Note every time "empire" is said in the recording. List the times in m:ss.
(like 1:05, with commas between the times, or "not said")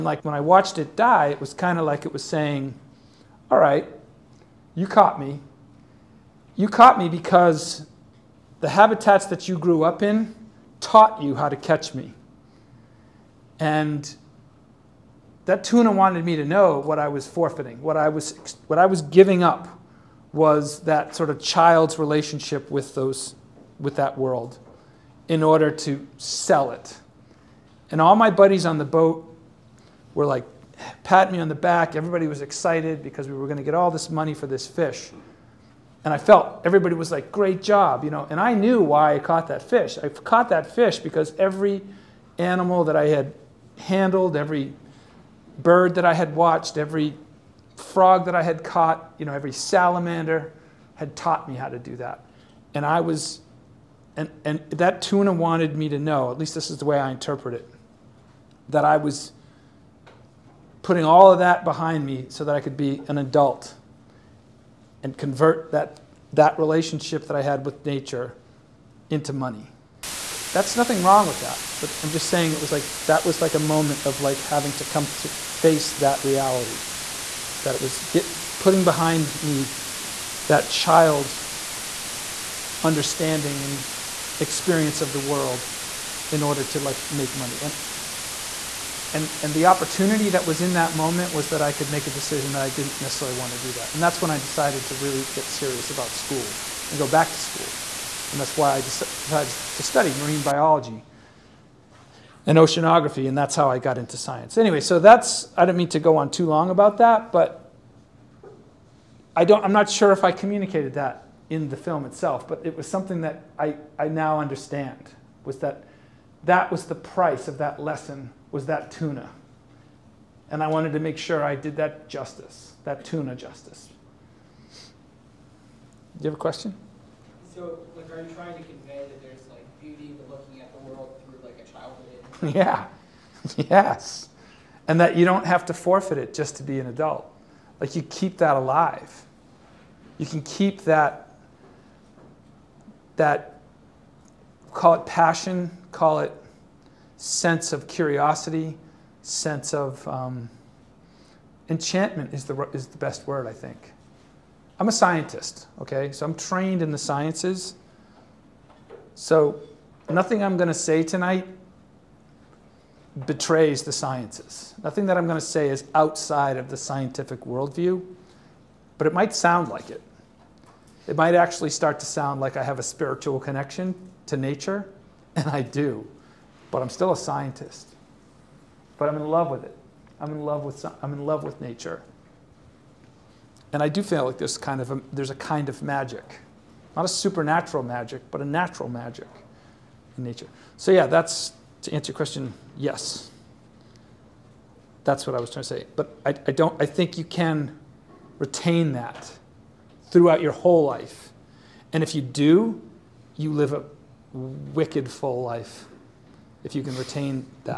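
not said.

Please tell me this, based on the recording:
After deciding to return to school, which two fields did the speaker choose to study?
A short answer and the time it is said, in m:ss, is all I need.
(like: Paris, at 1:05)
Marine biology and oceanography, at 1:40.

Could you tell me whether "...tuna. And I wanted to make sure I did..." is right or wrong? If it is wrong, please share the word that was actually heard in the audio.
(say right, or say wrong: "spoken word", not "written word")
right.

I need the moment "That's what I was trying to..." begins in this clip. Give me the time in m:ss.
3:15.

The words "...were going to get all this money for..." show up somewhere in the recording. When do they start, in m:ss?
0:33.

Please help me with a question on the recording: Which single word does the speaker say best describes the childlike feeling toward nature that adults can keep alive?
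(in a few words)
Enchantment.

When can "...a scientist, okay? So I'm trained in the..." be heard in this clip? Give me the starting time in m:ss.
2:34.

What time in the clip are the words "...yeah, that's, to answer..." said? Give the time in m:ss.
3:10.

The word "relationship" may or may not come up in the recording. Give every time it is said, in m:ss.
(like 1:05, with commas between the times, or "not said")
0:21, 1:06.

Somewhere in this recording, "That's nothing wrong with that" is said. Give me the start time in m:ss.
1:10.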